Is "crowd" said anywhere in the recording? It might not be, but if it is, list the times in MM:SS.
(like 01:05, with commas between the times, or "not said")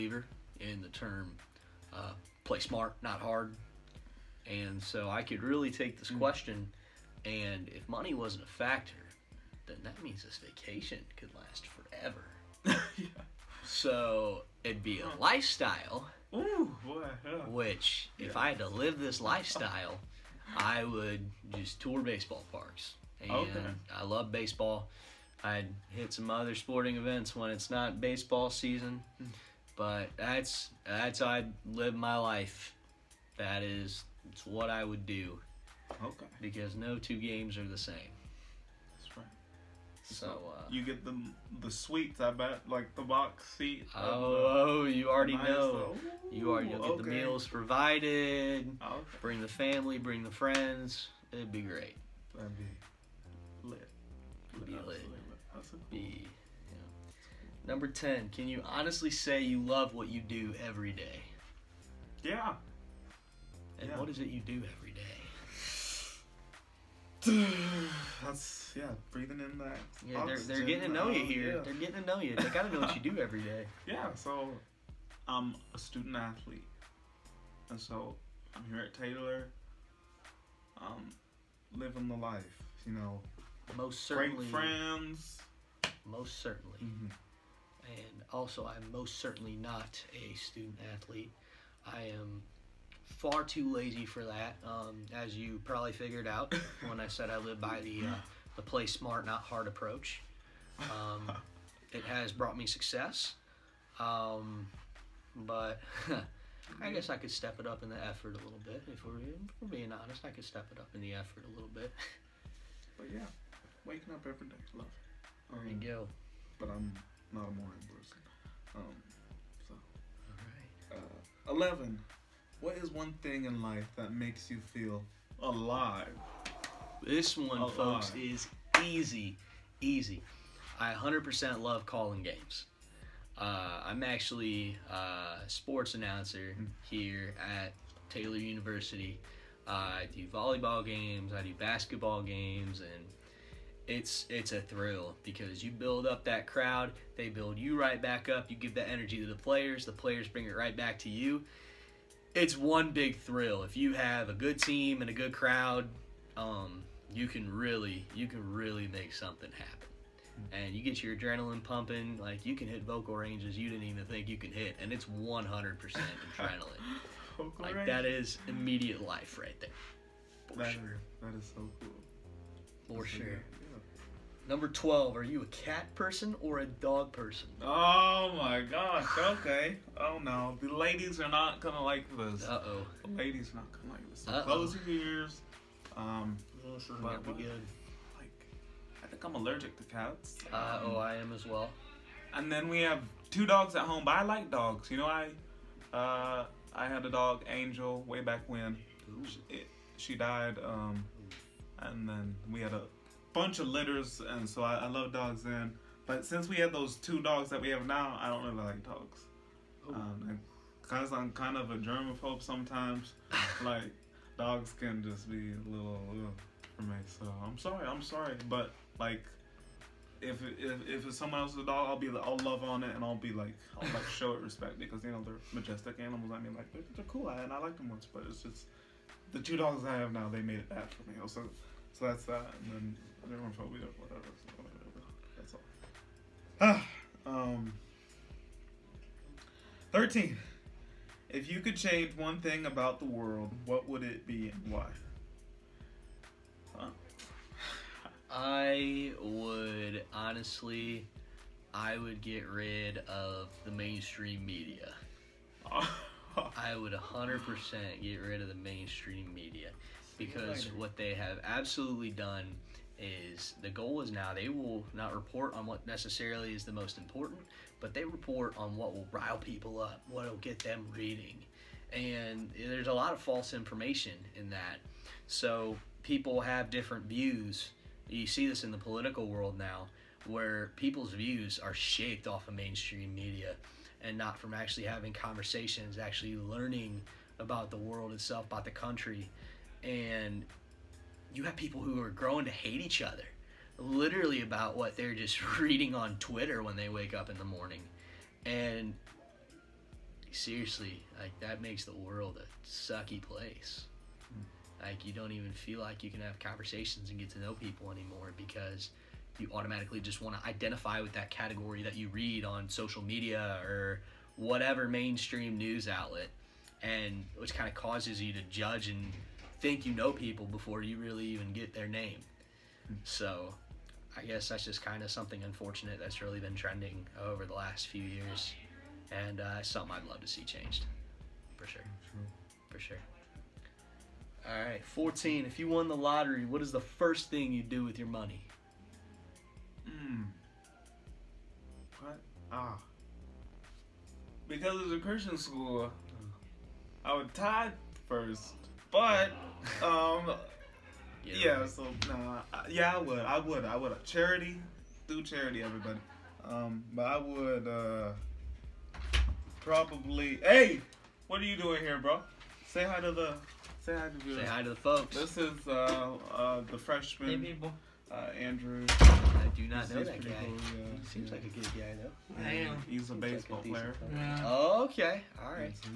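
02:26, 02:35.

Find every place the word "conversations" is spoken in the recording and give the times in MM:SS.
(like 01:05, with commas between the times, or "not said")
04:45, 05:06.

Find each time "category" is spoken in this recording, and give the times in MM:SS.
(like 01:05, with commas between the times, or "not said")
05:11.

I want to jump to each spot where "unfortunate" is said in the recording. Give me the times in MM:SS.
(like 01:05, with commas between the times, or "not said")
05:25.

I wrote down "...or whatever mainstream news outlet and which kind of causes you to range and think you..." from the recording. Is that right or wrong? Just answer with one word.
wrong.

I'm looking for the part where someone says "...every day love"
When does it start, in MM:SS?
01:54.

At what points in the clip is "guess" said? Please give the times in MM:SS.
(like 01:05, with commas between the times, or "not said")
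01:46, 05:24.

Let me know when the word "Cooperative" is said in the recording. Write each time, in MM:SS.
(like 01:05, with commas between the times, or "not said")
not said.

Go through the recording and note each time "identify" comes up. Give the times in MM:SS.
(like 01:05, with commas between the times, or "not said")
05:10.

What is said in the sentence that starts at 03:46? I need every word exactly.
I mean like they're, they're cool and I like them once, but it's just the two dogs I have now.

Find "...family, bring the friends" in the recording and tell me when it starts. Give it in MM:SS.
00:49.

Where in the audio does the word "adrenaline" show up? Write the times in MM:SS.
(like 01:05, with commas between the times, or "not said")
02:41, 02:45.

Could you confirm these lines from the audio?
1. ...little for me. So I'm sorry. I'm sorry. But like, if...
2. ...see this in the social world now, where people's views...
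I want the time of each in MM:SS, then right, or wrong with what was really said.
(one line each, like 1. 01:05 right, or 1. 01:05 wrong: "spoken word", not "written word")
1. 03:35 right
2. 04:38 wrong: "political", not "social".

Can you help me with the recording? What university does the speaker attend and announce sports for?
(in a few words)
Taylor University.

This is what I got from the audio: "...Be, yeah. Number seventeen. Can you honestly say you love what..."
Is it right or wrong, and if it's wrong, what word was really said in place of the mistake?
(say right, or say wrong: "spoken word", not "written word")
wrong: "ten", not "seventeen".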